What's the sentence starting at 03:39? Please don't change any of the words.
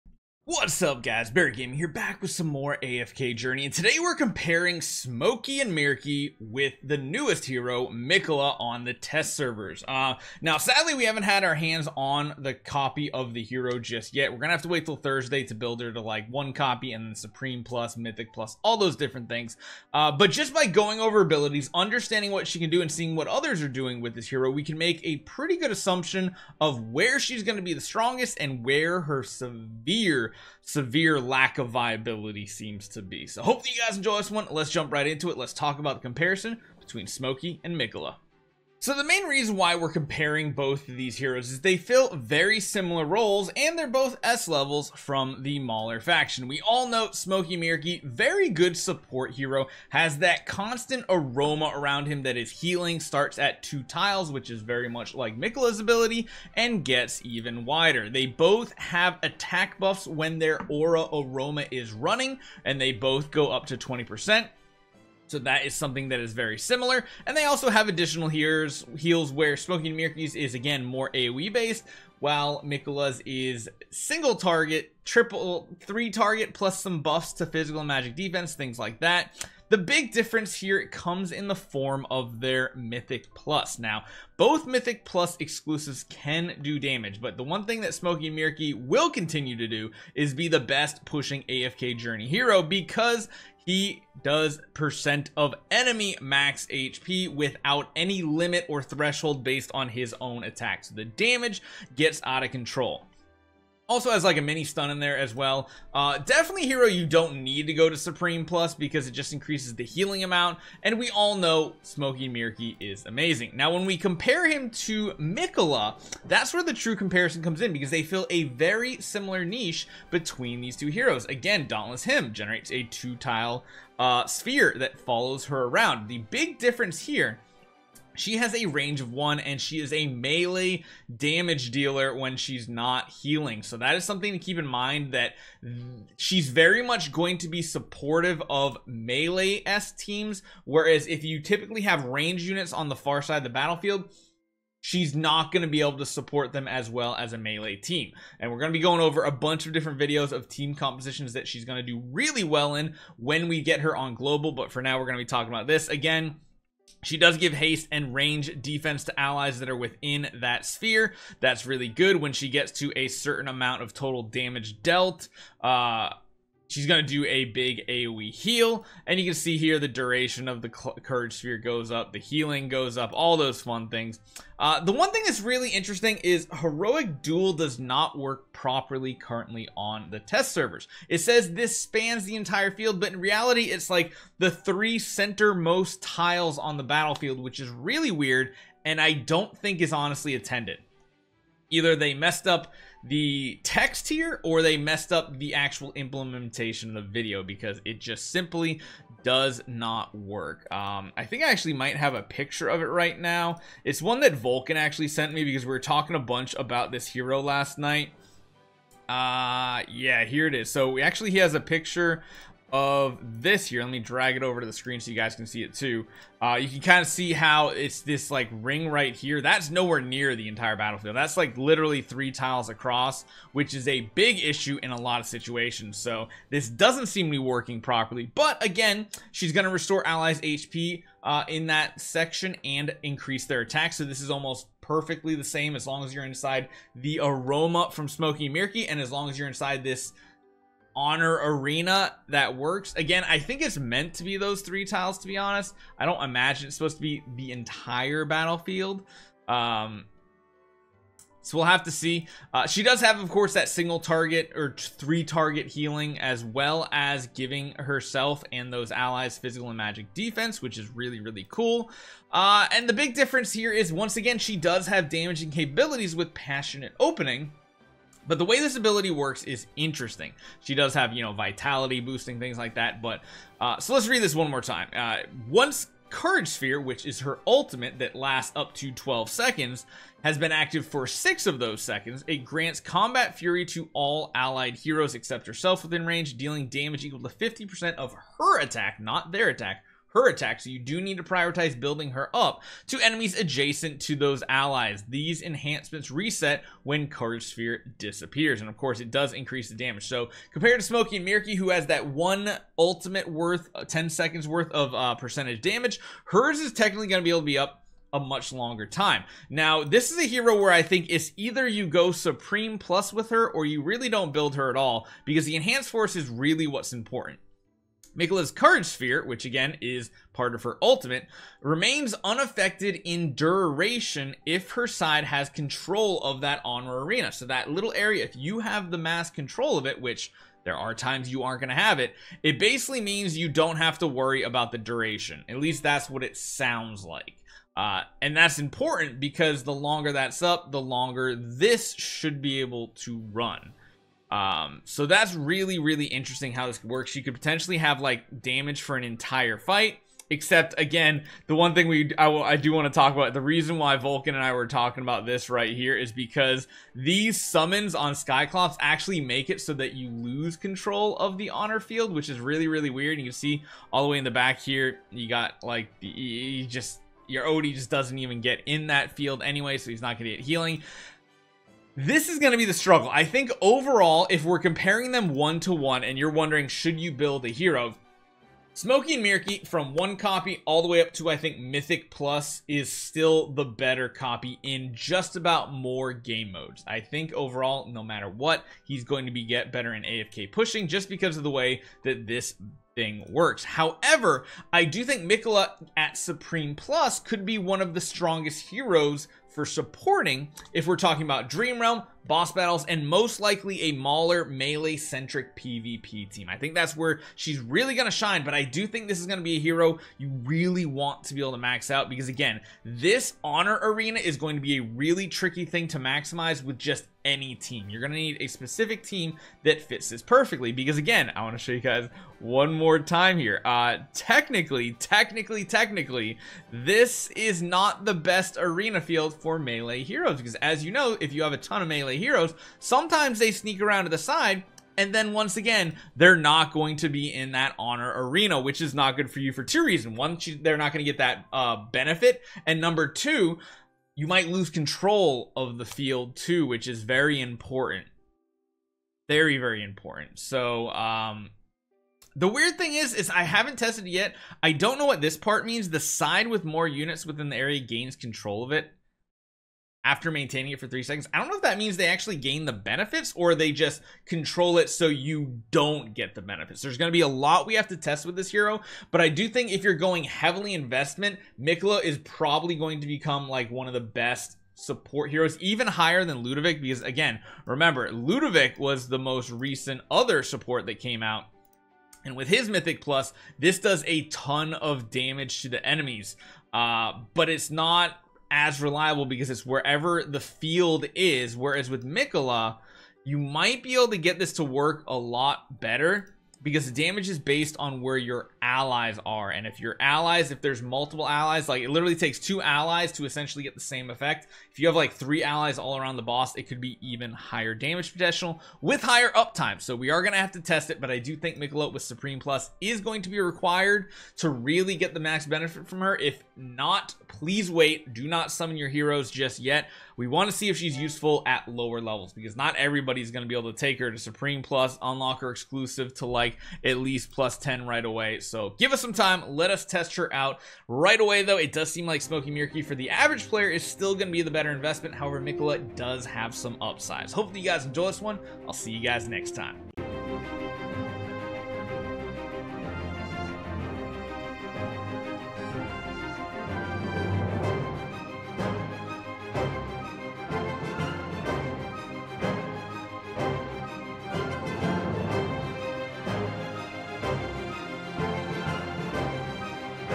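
That's nowhere near the entire battlefield.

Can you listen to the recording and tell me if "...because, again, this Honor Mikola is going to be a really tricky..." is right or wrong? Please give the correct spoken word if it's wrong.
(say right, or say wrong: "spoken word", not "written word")
wrong: "Arena", not "Mikola".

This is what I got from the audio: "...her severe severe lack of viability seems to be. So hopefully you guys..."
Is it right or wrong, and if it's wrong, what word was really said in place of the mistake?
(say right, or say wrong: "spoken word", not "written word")
right.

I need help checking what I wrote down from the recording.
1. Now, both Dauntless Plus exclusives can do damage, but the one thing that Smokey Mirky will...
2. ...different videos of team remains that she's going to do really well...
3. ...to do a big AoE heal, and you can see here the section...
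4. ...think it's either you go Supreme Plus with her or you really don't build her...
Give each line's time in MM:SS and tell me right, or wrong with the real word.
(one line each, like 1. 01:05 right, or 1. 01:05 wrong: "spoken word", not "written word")
1. 01:23 wrong: "Mythic", not "Dauntless"
2. 02:29 wrong: "compositions", not "remains"
3. 02:47 wrong: "duration", not "section"
4. 05:10 right.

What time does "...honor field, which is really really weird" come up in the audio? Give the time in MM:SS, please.
06:01.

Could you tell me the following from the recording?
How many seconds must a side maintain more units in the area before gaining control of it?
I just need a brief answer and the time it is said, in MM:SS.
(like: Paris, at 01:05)
3, at 07:40.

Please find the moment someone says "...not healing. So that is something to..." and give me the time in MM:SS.
02:12.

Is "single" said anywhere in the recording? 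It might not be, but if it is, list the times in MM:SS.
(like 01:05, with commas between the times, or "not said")
01:13, 04:13.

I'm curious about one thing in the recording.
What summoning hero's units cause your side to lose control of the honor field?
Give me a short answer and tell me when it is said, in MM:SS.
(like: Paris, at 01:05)
Skyclops, at 05:58.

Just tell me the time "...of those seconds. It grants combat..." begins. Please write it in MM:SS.
04:41.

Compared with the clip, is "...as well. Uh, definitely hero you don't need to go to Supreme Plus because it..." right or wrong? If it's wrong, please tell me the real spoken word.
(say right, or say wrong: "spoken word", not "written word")
right.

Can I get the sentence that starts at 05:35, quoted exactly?
At least that's what it sounds like.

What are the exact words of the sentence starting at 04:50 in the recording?
So you do need to prioritize building her up to enemies adjacent to those allies.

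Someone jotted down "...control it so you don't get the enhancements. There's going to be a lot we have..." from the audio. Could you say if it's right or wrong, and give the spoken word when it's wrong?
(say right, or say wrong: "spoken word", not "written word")
wrong: "benefits", not "enhancements".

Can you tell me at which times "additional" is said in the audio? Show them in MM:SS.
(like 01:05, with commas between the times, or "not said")
01:07.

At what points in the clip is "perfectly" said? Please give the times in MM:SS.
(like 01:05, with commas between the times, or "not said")
03:54, 07:00.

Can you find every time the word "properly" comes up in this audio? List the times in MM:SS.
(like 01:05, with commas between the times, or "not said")
02:58, 03:47.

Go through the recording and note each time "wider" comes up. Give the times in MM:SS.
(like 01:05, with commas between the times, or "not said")
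00:57.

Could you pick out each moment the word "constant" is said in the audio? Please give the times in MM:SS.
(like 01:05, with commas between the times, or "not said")
00:50.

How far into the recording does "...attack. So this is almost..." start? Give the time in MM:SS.
03:53.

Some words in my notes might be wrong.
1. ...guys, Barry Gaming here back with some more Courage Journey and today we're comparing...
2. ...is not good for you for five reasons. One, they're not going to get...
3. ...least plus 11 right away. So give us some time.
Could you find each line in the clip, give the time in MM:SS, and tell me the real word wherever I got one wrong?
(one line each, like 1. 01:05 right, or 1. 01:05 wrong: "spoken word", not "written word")
1. 00:01 wrong: "AFK", not "Courage"
2. 07:18 wrong: "two", not "five"
3. 08:46 wrong: "10", not "11".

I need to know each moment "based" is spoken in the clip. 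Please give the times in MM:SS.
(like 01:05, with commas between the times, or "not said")
01:11, 01:39, 08:17.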